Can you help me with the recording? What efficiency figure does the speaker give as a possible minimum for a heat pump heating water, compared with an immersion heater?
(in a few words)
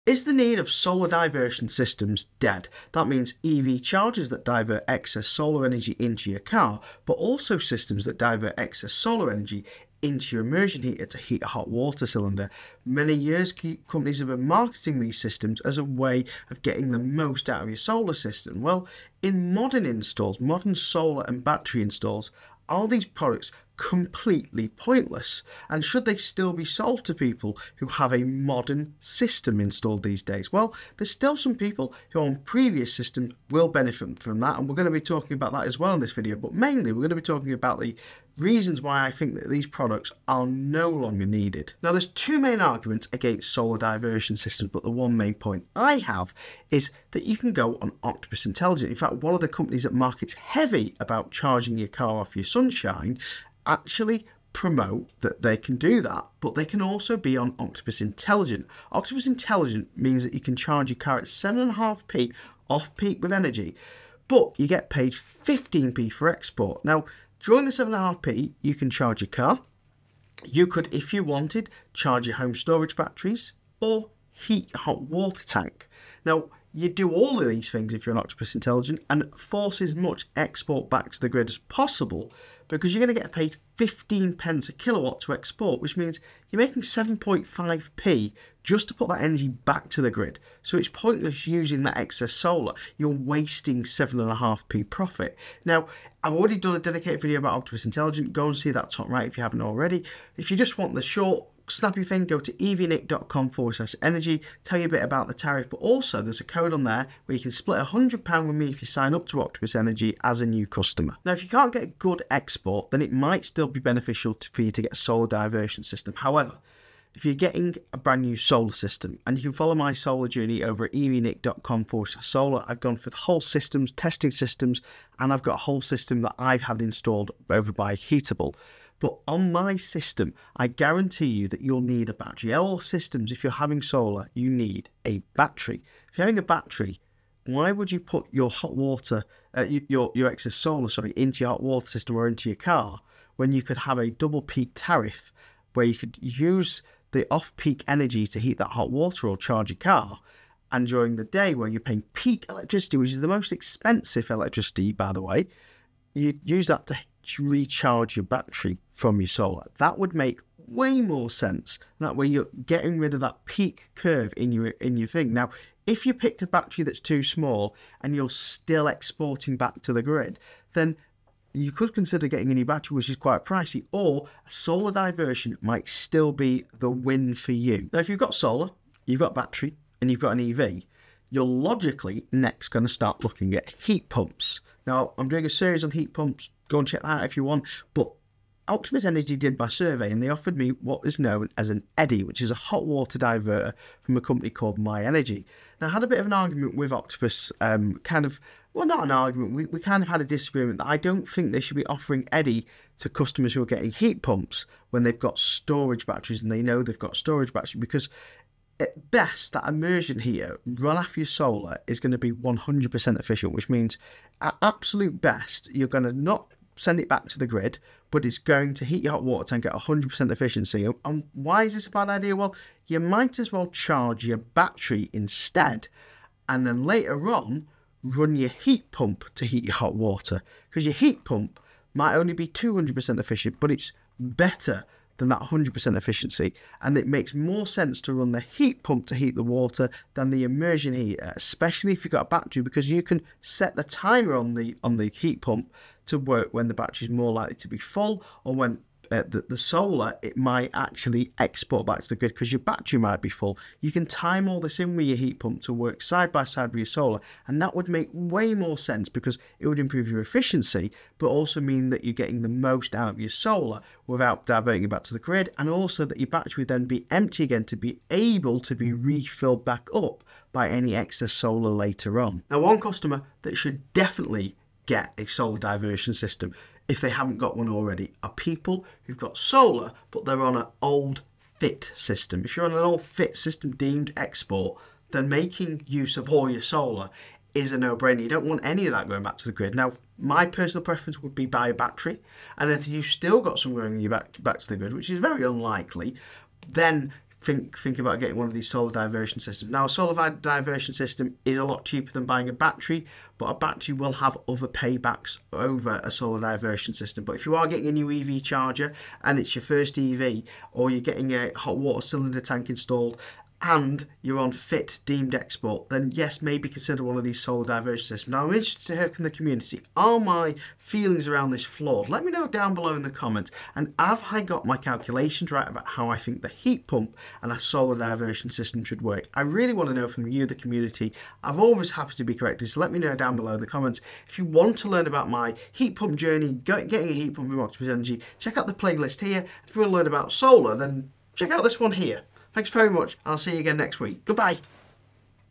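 200%.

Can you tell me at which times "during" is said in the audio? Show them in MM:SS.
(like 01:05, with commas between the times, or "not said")
01:07, 02:30.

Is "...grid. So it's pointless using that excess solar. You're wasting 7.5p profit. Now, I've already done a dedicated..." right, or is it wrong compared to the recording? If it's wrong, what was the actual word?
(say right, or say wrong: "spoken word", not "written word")
right.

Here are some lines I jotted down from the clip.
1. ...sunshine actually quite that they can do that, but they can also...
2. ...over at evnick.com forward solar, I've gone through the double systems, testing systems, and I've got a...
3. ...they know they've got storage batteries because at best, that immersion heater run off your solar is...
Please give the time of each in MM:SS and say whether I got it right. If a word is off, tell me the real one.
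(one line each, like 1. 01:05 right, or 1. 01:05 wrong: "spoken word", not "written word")
1. 00:52 wrong: "promote", not "quite"
2. 02:00 wrong: "whole", not "double"
3. 03:26 right.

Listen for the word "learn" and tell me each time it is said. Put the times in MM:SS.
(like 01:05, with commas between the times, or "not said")
05:34, 05:39.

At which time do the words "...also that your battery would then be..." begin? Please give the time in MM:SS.
04:25.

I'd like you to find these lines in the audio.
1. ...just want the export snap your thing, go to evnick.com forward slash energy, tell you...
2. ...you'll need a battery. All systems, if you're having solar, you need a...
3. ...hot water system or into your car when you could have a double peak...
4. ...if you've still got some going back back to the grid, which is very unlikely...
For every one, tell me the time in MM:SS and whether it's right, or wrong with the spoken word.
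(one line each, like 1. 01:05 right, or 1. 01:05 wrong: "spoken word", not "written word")
1. 01:40 wrong: "short", not "export"
2. 02:11 right
3. 02:21 right
4. 04:52 right.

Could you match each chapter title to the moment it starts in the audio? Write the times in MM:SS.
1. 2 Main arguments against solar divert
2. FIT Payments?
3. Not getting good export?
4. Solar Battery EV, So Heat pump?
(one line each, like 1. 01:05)
1. 00:41
2. 04:33
3. 01:52
4. 02:58.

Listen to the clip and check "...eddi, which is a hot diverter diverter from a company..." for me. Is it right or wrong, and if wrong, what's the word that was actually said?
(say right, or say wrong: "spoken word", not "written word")
wrong: "water", not "diverter".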